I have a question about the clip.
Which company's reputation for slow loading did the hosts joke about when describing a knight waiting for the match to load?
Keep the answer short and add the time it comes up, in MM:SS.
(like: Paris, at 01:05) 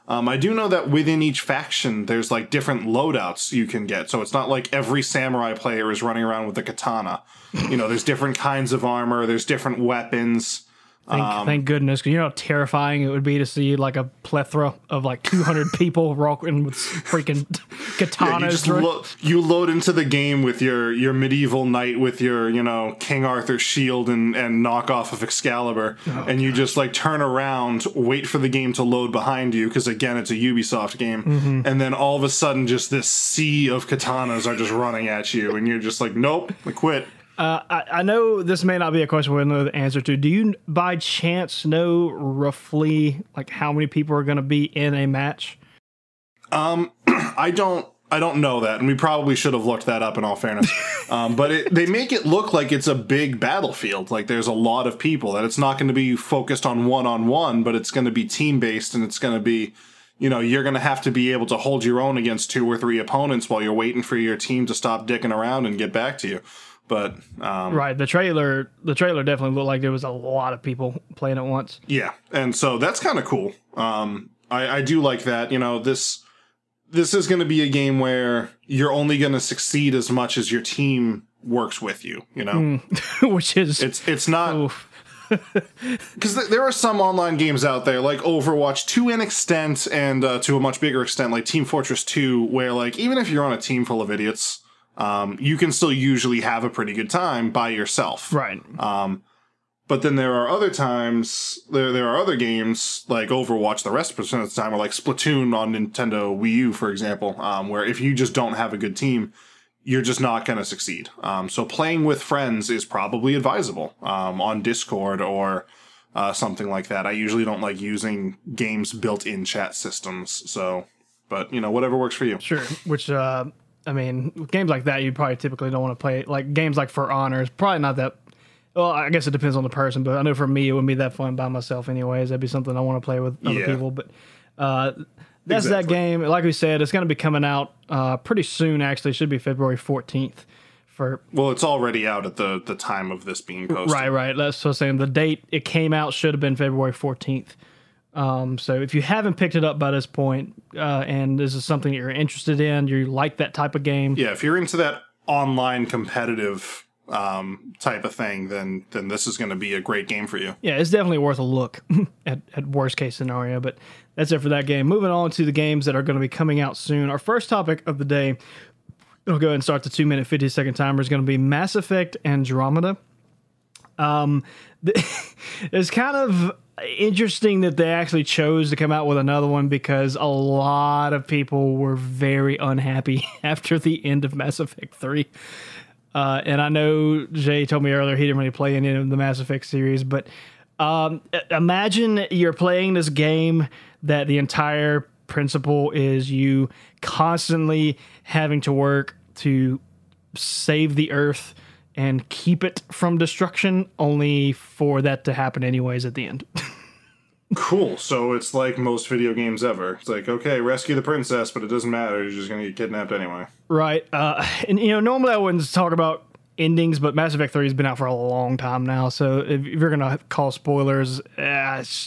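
Ubisoft, at 00:30.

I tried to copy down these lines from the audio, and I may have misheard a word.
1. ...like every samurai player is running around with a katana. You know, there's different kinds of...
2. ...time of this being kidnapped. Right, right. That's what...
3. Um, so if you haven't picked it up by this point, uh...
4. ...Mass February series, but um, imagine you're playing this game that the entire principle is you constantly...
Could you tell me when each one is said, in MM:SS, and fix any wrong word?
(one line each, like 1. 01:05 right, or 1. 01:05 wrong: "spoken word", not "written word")
1. 00:04 right
2. 02:22 wrong: "posted", not "kidnapped"
3. 02:28 right
4. 03:09 wrong: "Effect", not "February".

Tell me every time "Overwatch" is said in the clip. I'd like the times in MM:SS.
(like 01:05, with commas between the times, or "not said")
01:28, 01:43.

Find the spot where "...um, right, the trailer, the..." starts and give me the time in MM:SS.
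01:07.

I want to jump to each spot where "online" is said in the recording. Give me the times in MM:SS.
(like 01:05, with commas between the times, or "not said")
01:27, 02:35.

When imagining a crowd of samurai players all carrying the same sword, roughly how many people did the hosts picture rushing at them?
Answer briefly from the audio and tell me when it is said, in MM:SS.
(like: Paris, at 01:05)
200, at 00:15.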